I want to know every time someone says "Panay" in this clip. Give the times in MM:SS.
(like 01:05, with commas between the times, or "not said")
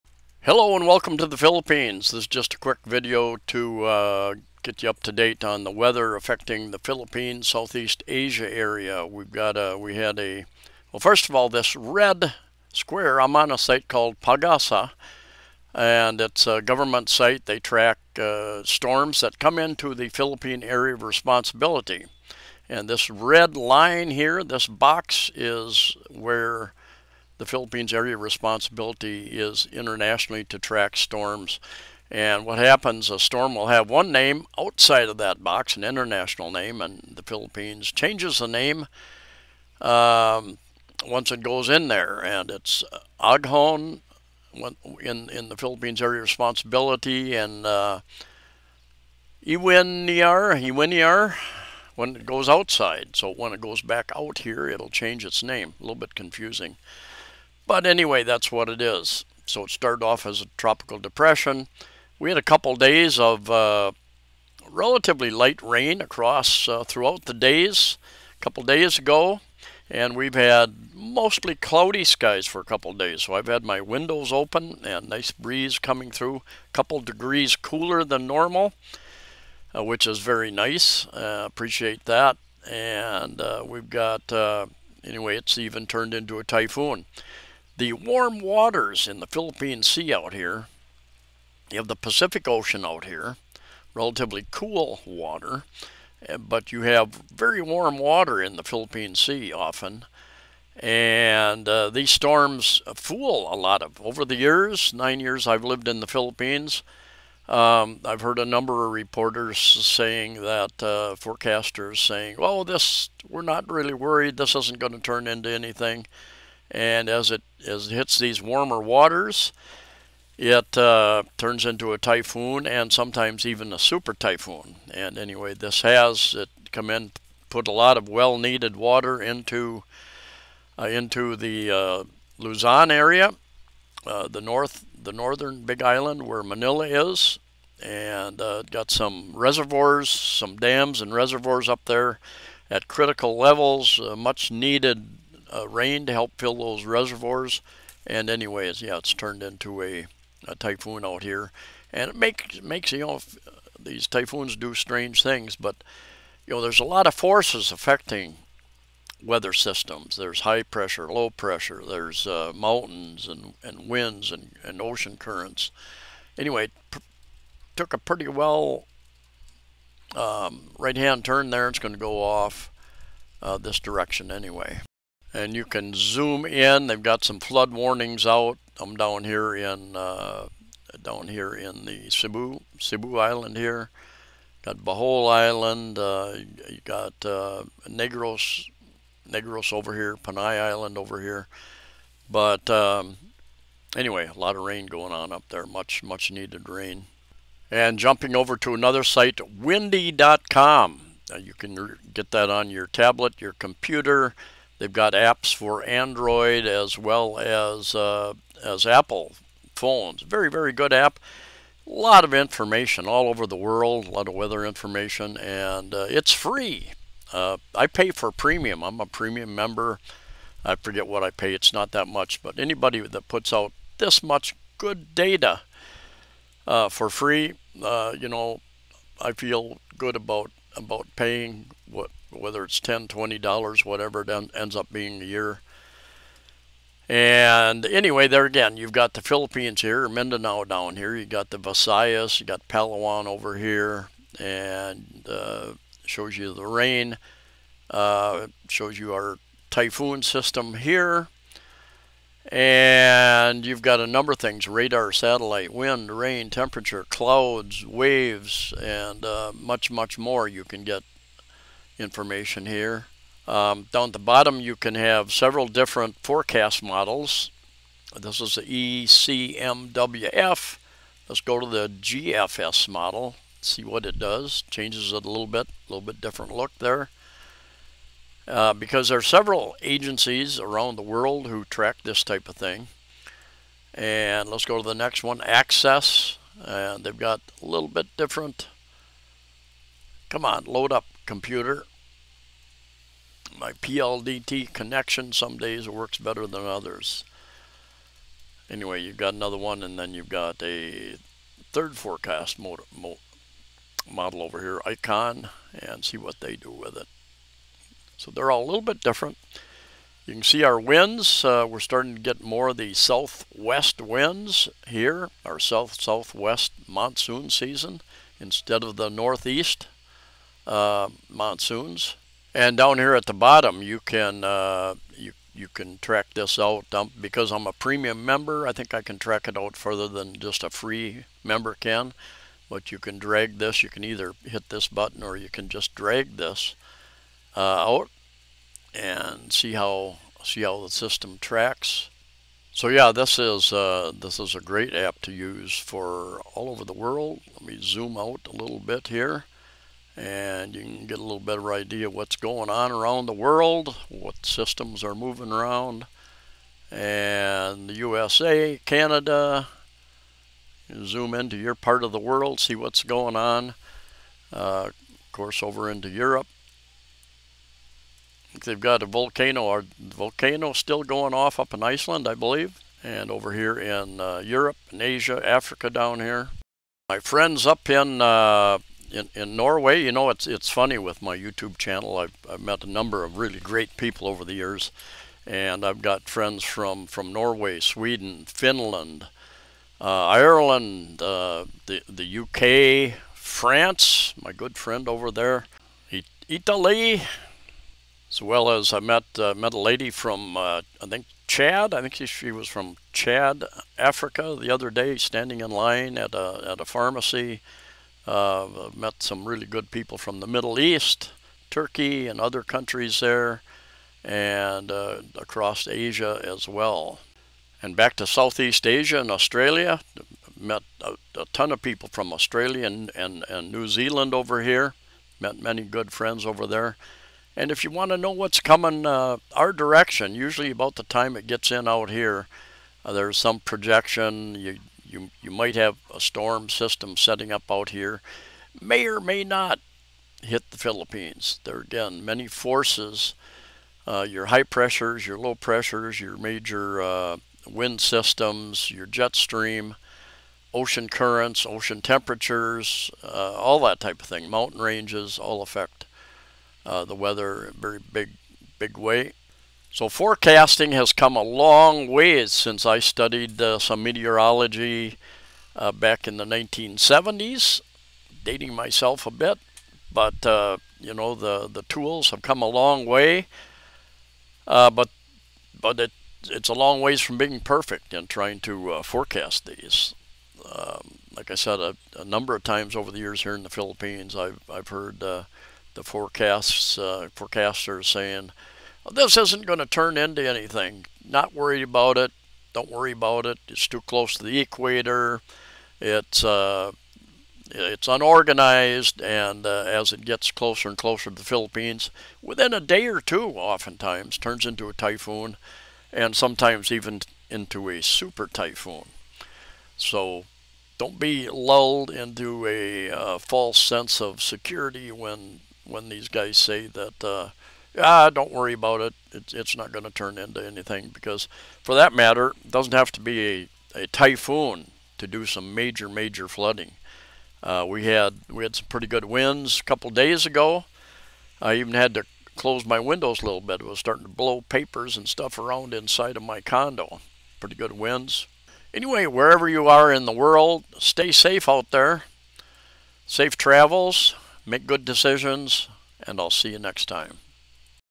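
03:10.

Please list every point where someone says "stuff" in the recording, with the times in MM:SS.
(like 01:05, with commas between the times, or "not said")
08:55.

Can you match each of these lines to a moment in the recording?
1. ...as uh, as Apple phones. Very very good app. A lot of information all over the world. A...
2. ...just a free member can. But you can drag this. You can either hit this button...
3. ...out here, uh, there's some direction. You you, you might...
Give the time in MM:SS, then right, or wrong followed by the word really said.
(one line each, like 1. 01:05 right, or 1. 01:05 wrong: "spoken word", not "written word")
1. 03:27 right
2. 05:30 right
3. 07:11 wrong: "projection", not "direction".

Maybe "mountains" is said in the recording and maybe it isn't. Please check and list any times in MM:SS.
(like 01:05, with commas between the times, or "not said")
02:42, 07:34.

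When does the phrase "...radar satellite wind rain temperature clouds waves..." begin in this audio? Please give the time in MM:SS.
04:14.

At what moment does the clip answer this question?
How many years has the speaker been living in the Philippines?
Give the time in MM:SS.
01:44.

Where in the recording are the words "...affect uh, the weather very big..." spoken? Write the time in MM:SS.
07:35.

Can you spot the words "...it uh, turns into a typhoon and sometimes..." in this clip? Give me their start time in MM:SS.
02:00.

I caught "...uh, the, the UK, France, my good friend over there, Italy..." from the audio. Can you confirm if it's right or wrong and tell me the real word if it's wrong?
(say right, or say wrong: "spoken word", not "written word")
right.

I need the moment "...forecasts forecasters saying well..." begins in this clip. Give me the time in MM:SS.
08:06.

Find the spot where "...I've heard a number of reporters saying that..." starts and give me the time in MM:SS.
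01:48.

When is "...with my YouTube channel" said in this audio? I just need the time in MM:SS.
06:20.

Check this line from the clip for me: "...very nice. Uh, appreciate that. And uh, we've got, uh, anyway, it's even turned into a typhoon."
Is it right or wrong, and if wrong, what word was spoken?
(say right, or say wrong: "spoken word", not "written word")
right.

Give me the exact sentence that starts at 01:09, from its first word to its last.
And we've had mostly cloudy skies for a couple days.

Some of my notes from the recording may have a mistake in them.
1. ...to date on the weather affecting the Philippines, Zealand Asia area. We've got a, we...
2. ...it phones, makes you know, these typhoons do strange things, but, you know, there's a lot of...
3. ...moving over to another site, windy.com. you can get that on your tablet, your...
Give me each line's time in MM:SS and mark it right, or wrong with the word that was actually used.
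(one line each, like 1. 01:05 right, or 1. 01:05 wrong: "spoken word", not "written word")
1. 00:05 wrong: "Southeast", not "Zealand"
2. 02:32 wrong: "makes", not "phones"
3. 03:17 wrong: "jumping", not "moving".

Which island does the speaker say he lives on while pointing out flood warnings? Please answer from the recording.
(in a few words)
Cebu.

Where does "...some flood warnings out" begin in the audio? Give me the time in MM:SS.
02:57.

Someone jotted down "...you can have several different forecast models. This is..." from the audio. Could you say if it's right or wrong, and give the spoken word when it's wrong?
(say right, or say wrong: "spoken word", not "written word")
right.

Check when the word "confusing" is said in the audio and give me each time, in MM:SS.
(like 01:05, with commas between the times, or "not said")
00:56.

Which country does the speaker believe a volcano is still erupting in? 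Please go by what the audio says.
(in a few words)
Iceland.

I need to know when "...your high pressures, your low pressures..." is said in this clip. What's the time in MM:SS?
07:24.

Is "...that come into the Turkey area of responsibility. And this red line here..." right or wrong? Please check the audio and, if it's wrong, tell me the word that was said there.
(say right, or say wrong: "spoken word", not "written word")
wrong: "Philippine", not "Turkey".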